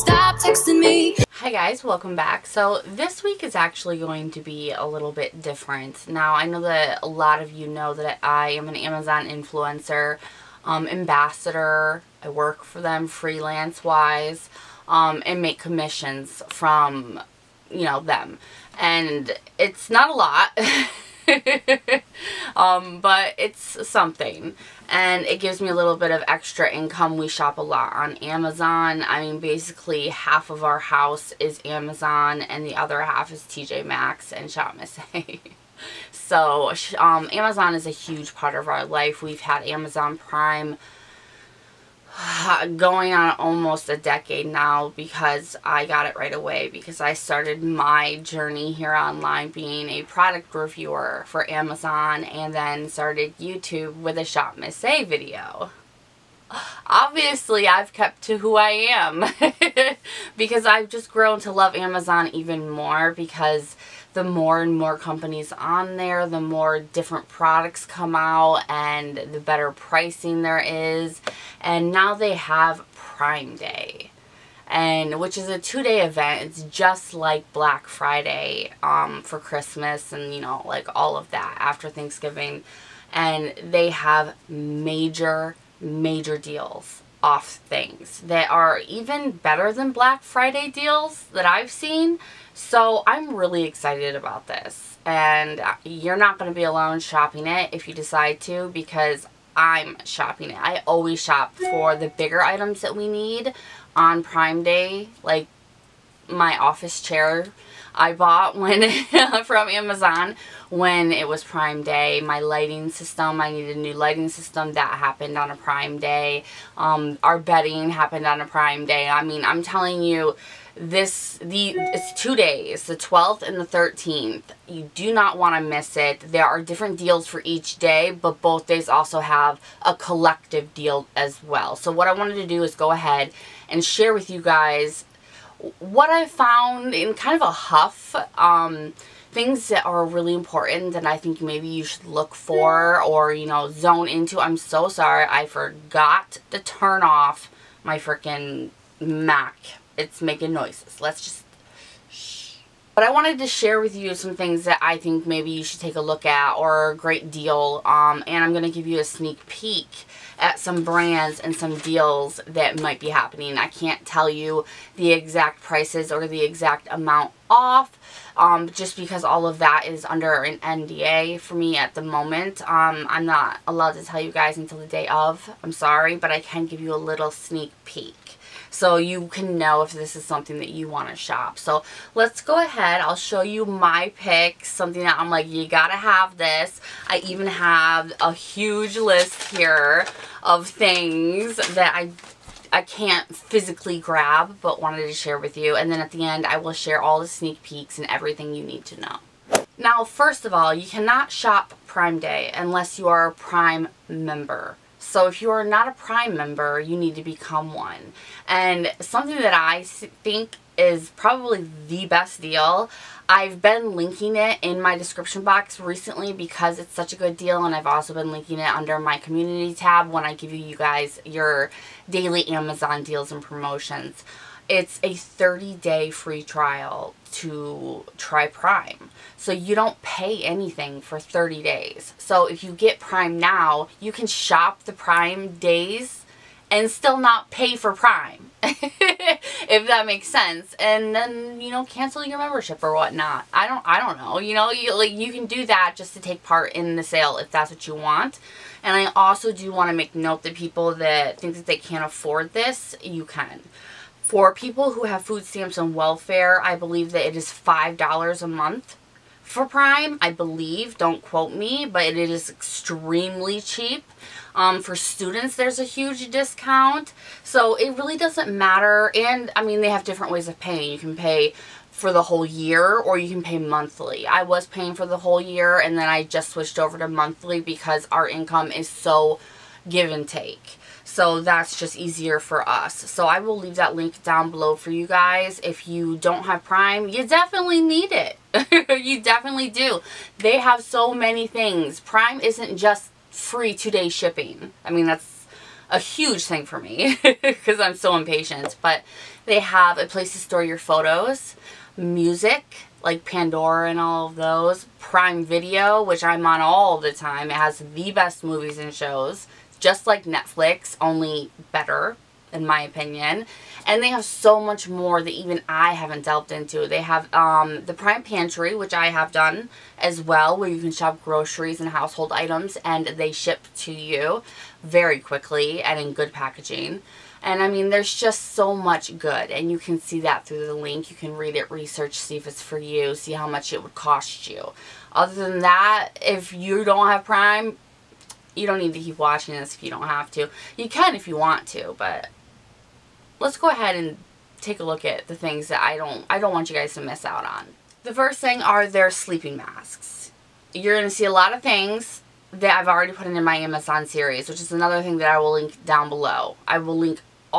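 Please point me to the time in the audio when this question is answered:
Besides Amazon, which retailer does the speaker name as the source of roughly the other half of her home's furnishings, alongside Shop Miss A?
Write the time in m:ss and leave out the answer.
0:33.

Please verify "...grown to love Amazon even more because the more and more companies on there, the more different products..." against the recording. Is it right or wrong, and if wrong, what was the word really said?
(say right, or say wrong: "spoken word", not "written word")
right.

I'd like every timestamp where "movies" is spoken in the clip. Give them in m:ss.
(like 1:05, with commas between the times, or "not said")
5:08.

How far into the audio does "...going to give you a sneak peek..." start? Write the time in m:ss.
2:38.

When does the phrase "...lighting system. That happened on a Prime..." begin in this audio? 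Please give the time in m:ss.
1:53.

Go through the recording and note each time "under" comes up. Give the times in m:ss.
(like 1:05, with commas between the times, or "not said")
2:50, 3:38.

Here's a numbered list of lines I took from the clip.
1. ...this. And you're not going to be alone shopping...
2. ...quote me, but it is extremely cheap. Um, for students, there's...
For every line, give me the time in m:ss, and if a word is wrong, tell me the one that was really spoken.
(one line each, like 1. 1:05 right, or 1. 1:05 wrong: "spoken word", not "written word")
1. 1:34 right
2. 4:21 right.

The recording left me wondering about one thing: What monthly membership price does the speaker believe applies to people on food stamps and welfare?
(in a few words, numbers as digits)
$5.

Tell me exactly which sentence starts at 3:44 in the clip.
It's a 30-day free trial to try Prime.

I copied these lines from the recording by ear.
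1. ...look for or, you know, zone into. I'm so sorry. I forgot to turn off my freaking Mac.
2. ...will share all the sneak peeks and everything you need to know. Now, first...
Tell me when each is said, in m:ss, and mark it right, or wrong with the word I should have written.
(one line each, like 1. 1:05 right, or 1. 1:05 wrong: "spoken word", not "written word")
1. 2:22 right
2. 3:16 right.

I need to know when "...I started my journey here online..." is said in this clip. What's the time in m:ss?
0:46.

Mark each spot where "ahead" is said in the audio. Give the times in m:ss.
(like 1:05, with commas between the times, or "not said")
2:12, 3:02, 5:43.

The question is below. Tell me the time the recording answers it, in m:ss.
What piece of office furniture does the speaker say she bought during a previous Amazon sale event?
1:46.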